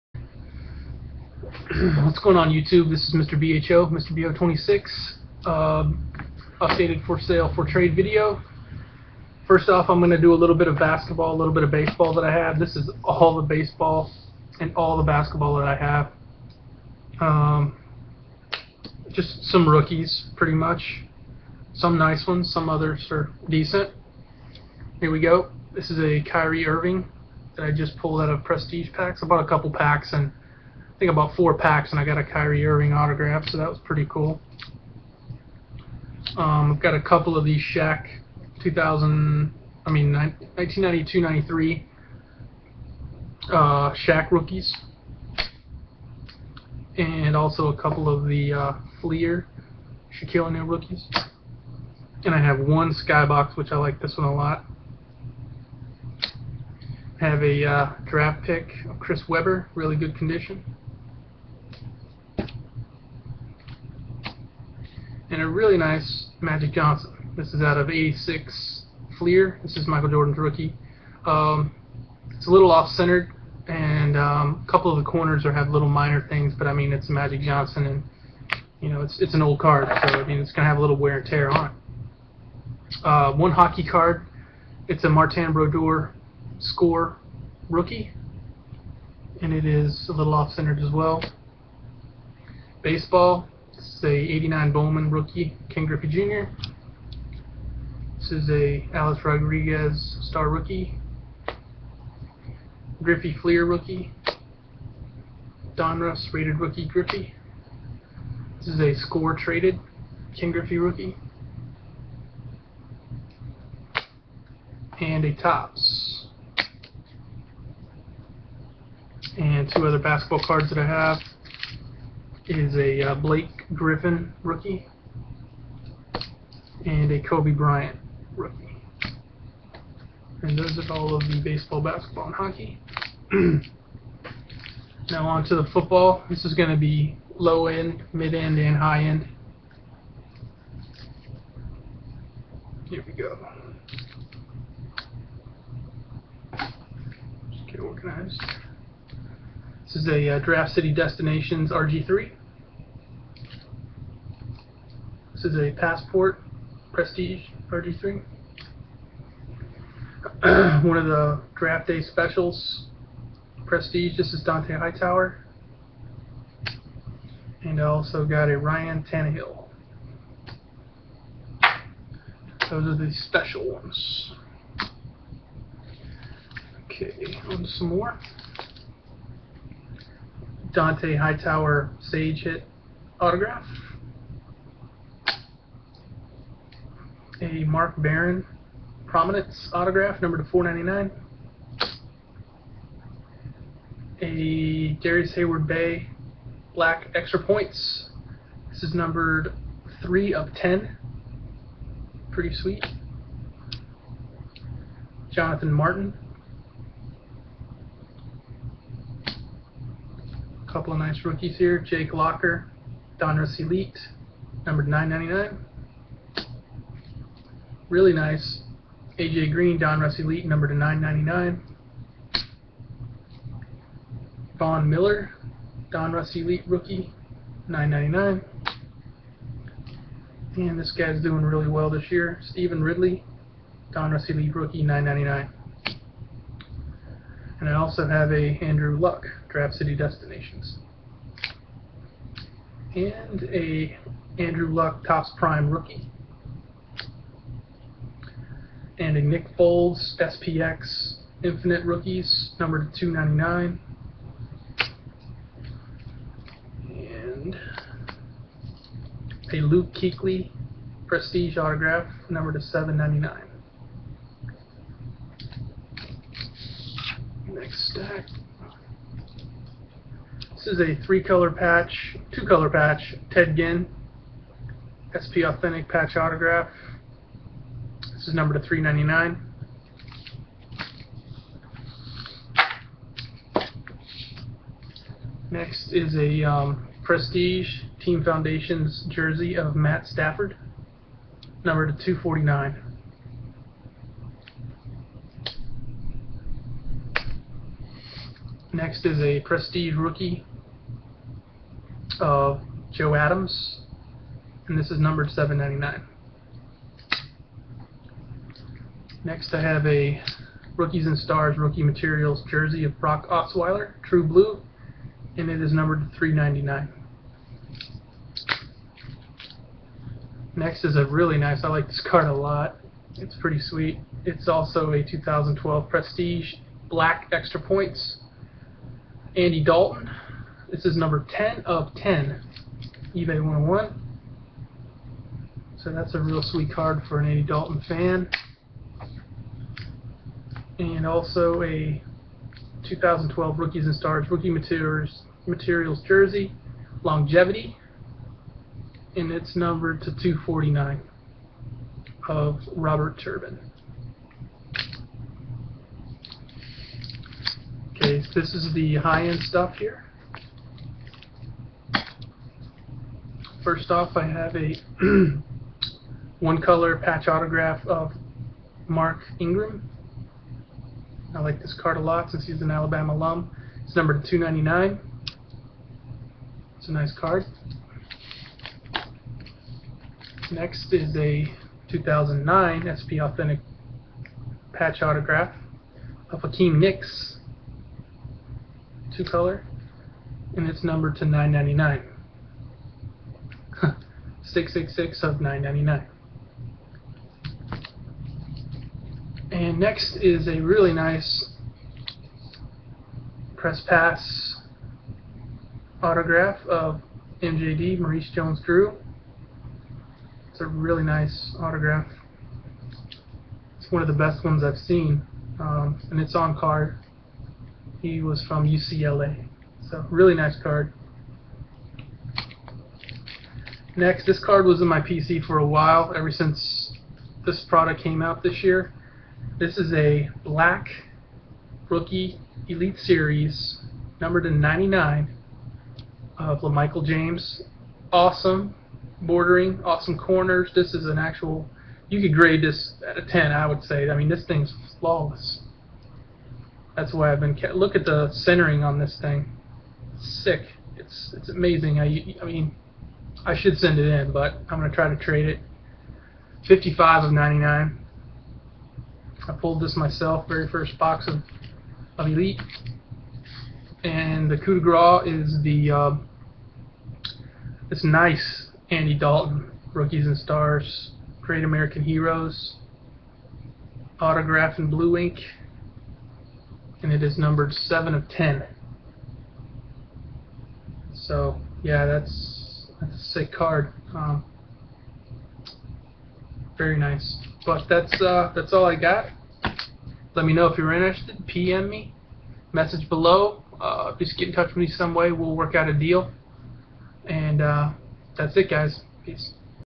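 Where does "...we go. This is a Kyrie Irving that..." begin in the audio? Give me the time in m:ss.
0:25.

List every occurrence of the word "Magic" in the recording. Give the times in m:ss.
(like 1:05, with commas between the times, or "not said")
1:06, 1:17.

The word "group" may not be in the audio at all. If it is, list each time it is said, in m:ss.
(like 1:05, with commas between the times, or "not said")
not said.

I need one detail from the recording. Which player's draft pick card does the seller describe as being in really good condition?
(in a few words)
Chris Webber.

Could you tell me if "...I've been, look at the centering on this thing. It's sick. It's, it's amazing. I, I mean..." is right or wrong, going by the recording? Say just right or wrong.
right.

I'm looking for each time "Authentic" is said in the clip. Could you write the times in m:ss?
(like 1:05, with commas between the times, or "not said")
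4:35, 6:23.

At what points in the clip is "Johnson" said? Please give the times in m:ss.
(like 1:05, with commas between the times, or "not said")
1:06, 1:17.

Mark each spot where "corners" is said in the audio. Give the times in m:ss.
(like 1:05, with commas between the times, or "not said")
1:15, 7:20.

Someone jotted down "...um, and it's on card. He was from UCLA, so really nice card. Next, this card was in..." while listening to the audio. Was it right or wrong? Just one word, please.
right.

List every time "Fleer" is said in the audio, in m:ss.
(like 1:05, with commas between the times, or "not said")
0:49, 1:09, 1:43.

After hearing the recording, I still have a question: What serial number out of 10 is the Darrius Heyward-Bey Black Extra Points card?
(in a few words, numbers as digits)
3.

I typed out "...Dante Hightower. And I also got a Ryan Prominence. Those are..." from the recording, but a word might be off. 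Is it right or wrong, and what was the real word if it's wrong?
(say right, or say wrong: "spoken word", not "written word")
wrong: "Tannehill", not "Prominence".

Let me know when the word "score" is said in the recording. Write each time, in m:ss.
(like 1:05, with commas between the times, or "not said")
1:26, 1:48.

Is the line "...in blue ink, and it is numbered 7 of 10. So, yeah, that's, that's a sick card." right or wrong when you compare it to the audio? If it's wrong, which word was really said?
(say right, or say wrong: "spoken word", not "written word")
right.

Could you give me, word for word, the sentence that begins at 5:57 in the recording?
Okay, so this is the high-end stuff here.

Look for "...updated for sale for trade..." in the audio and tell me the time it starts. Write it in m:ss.
0:06.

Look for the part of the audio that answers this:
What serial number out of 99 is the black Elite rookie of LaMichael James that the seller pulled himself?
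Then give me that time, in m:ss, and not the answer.
7:36.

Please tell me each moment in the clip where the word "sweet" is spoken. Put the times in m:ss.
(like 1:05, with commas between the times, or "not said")
3:22, 5:23, 5:36.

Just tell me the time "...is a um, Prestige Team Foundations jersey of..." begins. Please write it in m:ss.
4:45.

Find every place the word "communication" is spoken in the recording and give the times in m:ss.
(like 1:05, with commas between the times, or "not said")
not said.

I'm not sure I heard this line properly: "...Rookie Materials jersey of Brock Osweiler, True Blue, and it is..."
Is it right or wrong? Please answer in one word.
right.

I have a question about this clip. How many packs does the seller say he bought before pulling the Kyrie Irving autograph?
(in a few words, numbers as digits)
4.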